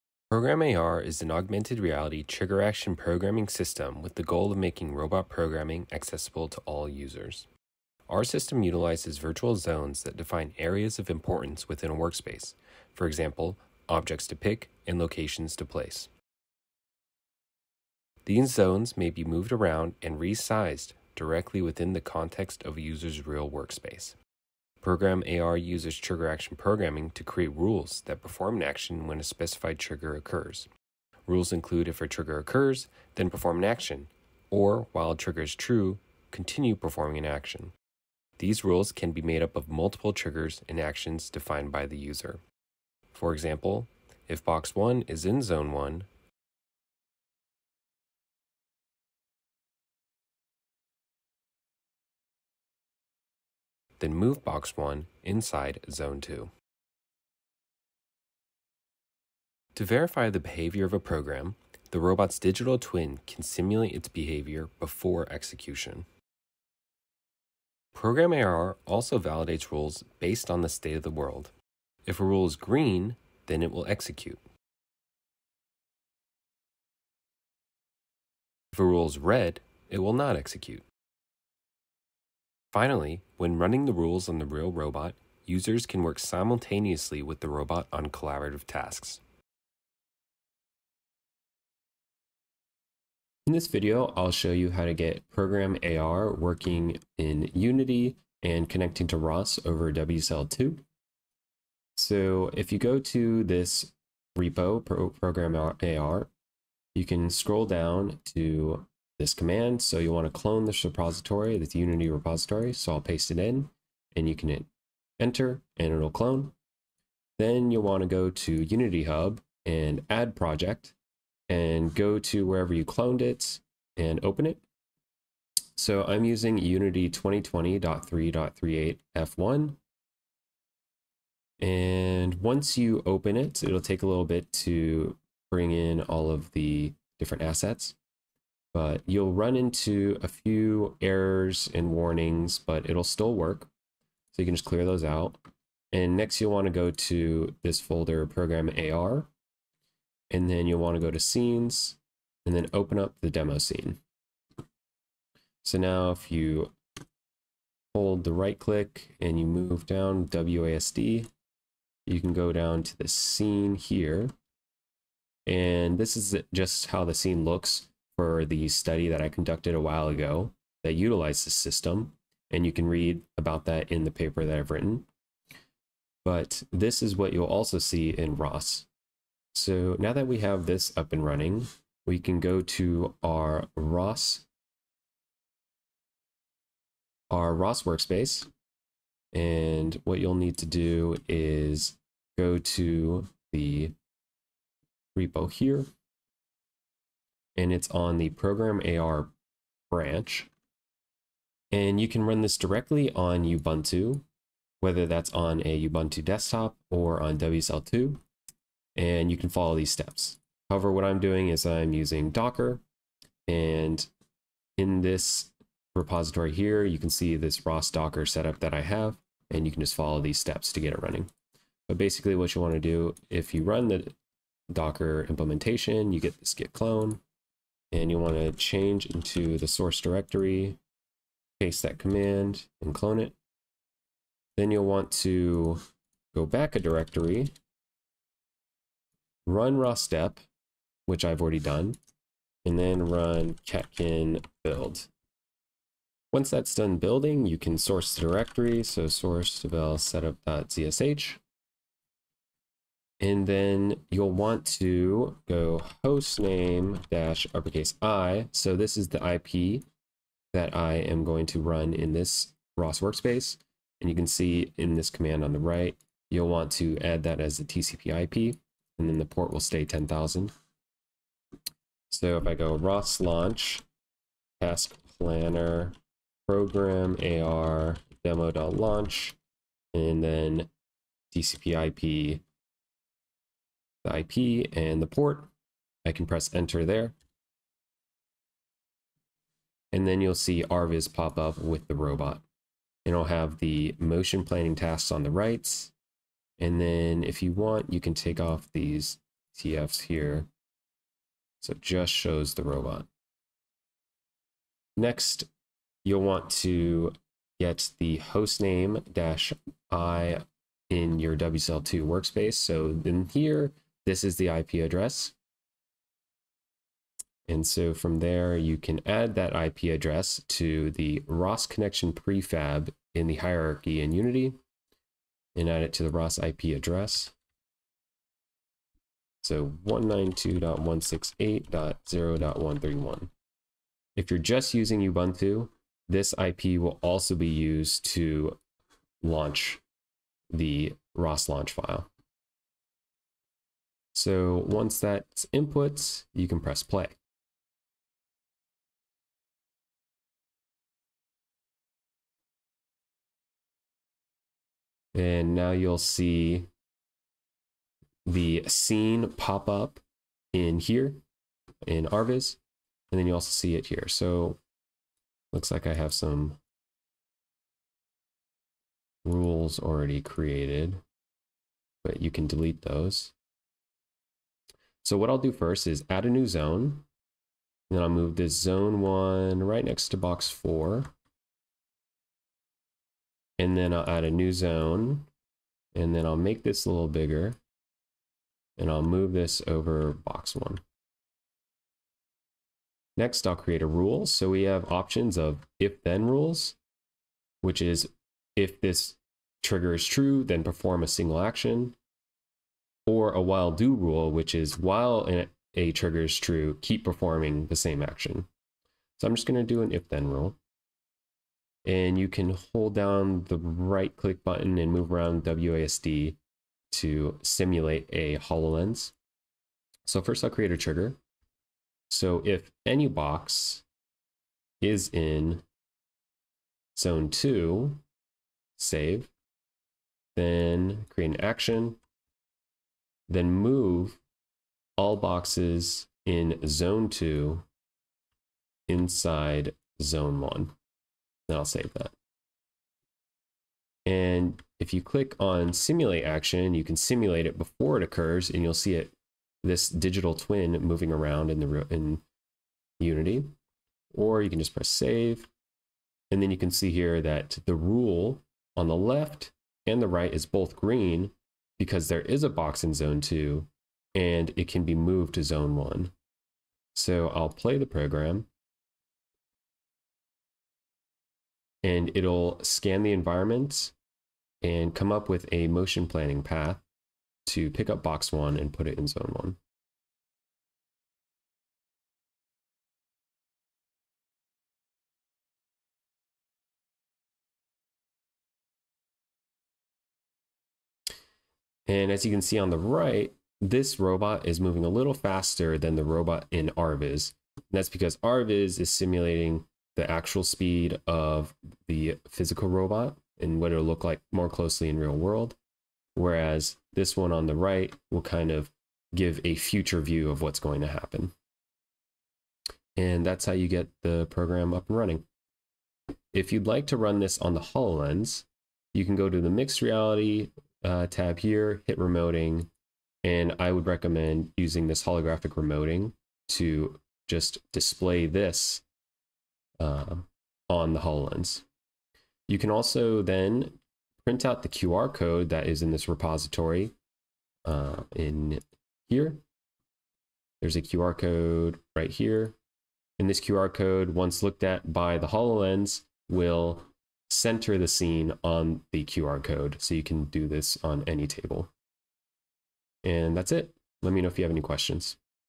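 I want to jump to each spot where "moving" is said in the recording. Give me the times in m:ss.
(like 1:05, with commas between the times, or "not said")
7:30, 8:14.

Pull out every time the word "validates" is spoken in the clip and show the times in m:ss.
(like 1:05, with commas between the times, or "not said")
1:09.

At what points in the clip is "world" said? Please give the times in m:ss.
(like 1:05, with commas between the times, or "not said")
1:11, 8:25.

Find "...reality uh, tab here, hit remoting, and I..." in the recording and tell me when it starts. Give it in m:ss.
8:39.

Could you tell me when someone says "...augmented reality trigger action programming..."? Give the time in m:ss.
0:01.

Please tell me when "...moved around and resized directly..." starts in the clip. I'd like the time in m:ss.
0:19.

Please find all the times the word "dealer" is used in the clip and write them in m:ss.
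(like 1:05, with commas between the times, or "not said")
not said.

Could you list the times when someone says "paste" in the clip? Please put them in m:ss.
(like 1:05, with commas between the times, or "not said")
1:53, 3:51.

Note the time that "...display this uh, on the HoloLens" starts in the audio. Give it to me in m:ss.
8:47.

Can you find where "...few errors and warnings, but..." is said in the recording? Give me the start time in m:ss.
2:20.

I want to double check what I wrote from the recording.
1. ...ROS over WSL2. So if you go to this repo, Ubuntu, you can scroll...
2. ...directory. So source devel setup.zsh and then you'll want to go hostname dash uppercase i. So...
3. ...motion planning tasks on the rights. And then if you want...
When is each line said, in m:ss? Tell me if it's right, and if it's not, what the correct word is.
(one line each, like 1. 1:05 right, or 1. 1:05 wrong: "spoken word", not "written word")
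1. 1:39 wrong: "PRogramAR", not "Ubuntu"
2. 4:08 right
3. 4:53 right.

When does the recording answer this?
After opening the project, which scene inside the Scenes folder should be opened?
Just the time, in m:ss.
2:33.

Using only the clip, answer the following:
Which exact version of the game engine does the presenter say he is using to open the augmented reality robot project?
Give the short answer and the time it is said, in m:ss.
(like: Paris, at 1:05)
2020.3.38 F1, at 2:07.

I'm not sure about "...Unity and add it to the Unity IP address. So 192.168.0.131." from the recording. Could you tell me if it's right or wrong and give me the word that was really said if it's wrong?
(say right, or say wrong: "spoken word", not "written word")
wrong: "ROS", not "Unity".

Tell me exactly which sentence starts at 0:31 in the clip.
Rules include if a trigger occurs, then perform an action, or while a trigger is true, continue performing an action.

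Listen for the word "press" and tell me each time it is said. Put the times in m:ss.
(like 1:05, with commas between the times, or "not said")
4:46, 5:46, 7:34.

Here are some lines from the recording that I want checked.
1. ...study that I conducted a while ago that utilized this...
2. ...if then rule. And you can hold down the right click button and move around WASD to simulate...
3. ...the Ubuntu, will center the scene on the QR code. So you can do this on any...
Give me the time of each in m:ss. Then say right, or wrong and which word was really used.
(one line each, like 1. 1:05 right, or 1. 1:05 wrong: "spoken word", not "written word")
1. 2:48 right
2. 6:49 right
3. 9:05 wrong: "HoloLens", not "Ubuntu".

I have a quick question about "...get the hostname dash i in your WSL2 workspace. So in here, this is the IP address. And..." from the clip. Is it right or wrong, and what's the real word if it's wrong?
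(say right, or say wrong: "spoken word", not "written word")
right.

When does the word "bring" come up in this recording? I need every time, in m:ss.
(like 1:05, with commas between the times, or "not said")
2:15.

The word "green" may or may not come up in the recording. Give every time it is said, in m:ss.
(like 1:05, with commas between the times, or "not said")
1:12, 7:40.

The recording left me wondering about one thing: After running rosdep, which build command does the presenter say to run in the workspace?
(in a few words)
catkin build.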